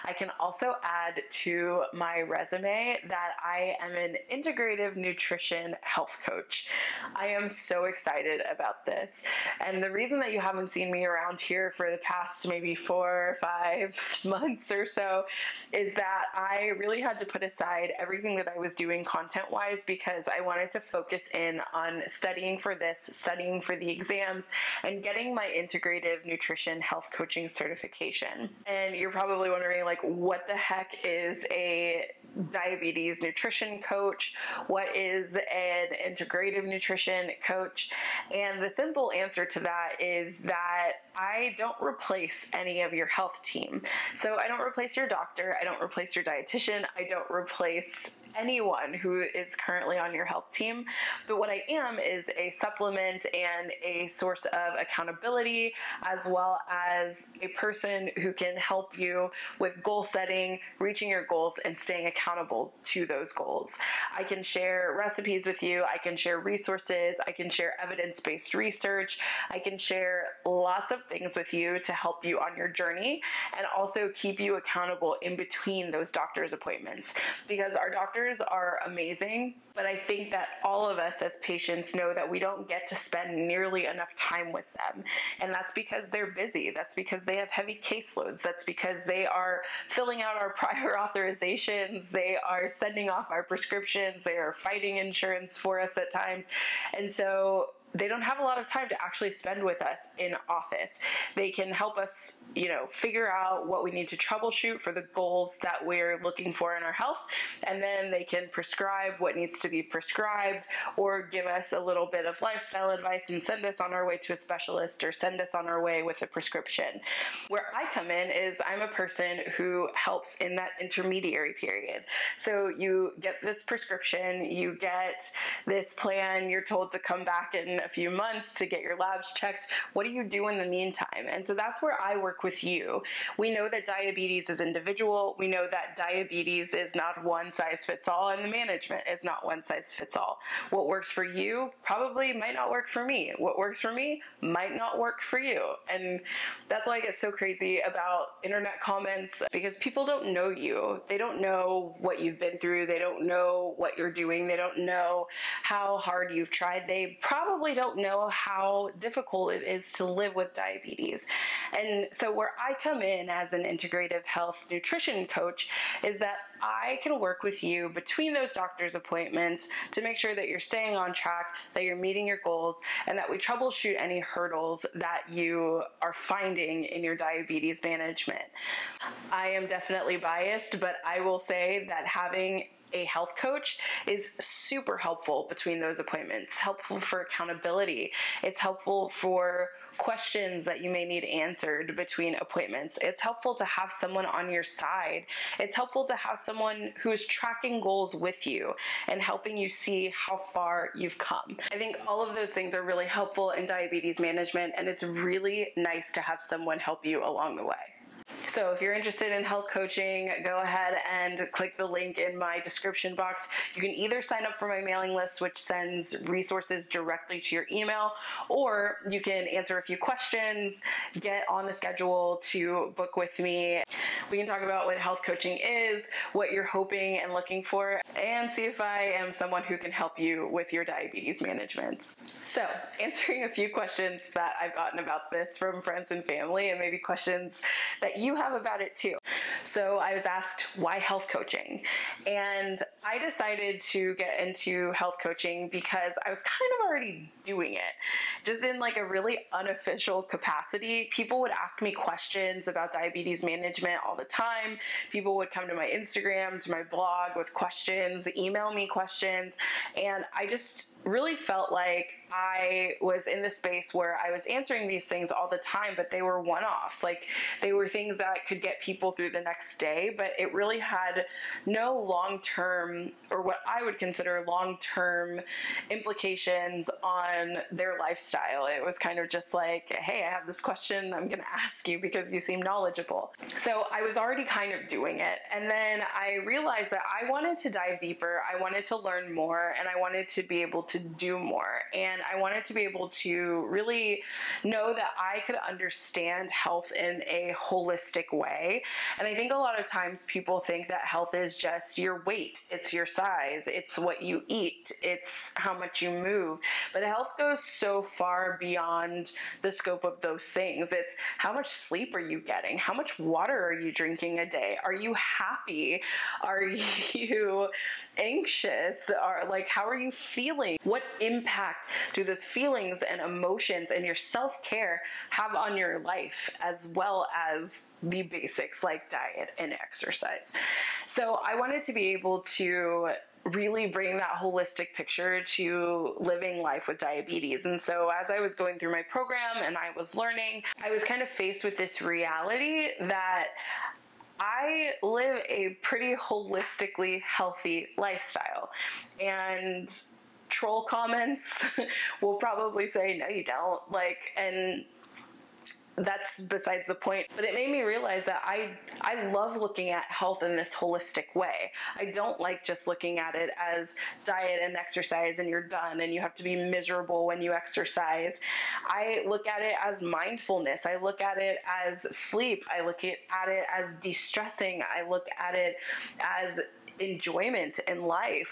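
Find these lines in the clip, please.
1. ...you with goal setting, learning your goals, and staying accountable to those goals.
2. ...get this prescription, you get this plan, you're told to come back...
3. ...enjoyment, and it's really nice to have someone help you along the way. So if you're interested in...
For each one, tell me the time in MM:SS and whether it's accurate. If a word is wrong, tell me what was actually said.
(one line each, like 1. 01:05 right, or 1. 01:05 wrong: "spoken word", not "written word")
1. 00:58 wrong: "reaching", not "learning"
2. 02:03 right
3. 03:24 wrong: "management", not "enjoyment".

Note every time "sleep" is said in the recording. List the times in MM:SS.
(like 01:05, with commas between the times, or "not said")
05:11, 06:12.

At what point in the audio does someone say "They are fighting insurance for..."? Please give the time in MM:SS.
01:34.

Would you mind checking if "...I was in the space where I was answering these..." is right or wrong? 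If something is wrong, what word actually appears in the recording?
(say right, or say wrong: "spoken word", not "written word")
right.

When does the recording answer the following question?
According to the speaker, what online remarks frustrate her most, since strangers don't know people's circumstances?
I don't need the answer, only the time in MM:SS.
02:28.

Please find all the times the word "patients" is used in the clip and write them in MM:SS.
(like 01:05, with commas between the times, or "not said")
01:21.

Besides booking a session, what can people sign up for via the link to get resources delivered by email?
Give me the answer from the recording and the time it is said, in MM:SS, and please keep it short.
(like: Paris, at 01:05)
mailing list, at 03:34.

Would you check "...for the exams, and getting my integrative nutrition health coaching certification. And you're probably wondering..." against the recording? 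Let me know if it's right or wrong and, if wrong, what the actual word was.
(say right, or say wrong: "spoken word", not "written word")
right.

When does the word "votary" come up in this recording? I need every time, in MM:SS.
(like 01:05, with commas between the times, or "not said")
not said.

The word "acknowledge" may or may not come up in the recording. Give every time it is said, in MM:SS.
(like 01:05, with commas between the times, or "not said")
not said.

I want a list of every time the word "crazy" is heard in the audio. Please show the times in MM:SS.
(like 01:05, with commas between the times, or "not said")
02:27.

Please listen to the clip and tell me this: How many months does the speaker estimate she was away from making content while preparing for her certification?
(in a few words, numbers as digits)
4 or 5.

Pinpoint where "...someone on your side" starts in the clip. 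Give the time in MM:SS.
03:13.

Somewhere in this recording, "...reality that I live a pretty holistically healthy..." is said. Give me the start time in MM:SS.
05:41.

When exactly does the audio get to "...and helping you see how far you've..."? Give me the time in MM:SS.
03:19.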